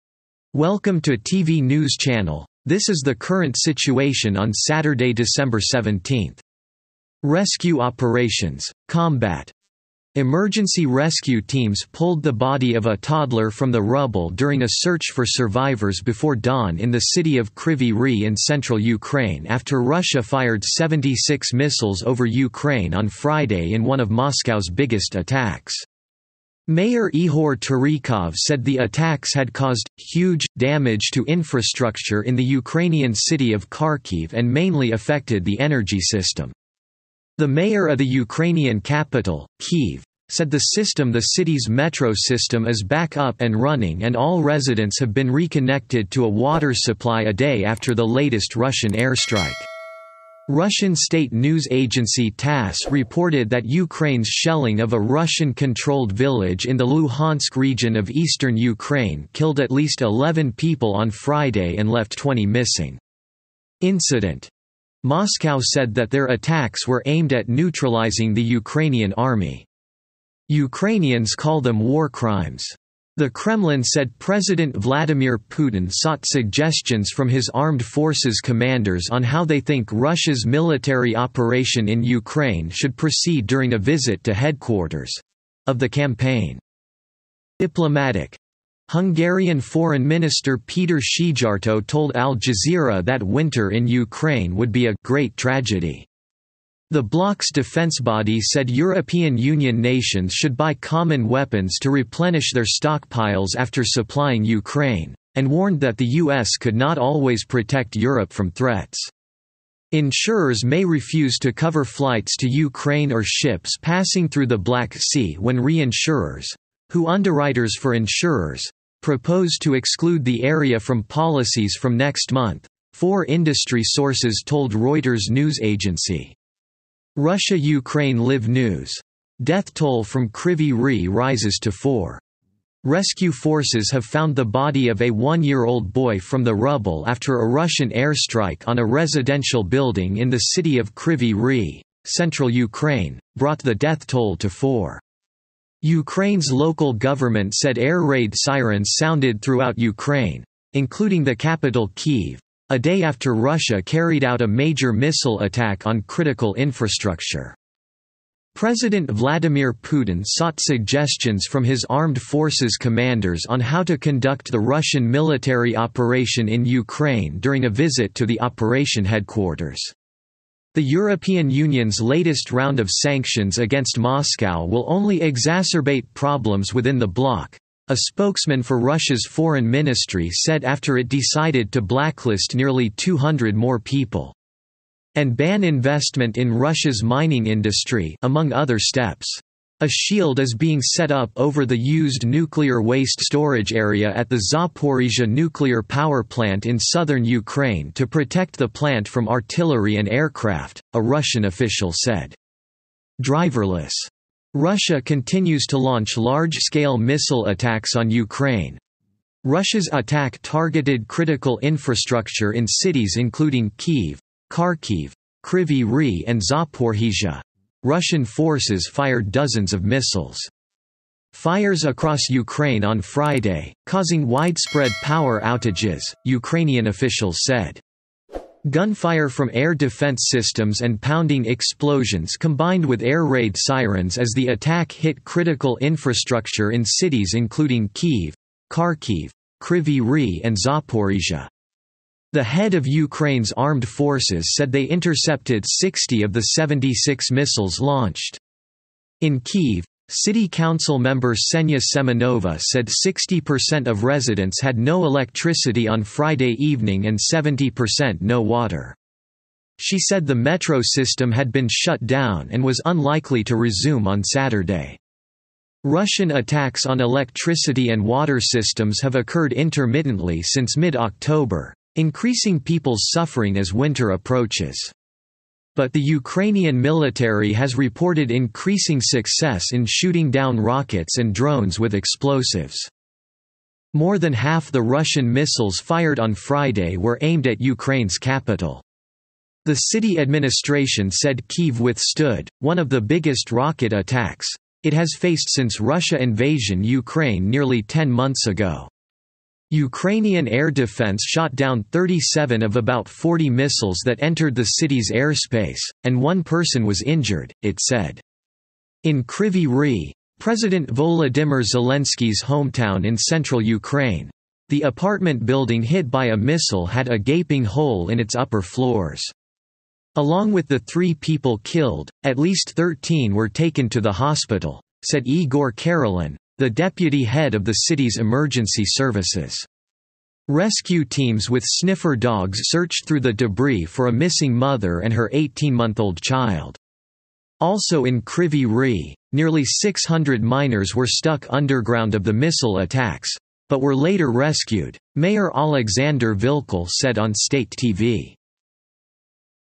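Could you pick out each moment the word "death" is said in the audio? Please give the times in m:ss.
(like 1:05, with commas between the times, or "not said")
2:09, 2:23.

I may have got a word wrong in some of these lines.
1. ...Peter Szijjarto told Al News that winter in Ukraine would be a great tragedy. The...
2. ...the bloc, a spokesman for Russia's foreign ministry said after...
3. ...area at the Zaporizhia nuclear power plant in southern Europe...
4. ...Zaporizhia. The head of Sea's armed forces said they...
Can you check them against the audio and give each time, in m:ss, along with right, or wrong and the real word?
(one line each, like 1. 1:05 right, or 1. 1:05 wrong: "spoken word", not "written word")
1. 1:30 wrong: "Jazeera", not "News"
2. 2:56 right
3. 3:13 wrong: "Ukraine", not "Europe"
4. 4:00 wrong: "Ukraine", not "Sea".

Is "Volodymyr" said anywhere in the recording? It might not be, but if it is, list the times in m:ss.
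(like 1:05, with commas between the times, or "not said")
5:10.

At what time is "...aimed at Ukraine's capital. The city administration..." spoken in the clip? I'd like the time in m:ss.
4:47.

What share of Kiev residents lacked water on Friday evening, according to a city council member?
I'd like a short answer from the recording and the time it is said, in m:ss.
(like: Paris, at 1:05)
70%, at 4:17.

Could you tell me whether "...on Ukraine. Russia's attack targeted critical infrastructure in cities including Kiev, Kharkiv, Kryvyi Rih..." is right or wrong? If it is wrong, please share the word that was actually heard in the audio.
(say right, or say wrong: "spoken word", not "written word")
right.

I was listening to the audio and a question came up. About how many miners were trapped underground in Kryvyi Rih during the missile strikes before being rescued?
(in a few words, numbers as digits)
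600.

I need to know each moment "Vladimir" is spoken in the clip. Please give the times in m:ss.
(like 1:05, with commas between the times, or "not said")
1:14, 2:39.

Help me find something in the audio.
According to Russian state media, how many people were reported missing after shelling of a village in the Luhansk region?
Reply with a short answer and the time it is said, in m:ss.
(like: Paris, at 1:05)
20, at 1:02.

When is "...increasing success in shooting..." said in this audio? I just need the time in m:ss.
4:38.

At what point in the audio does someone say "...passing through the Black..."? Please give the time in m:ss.
1:53.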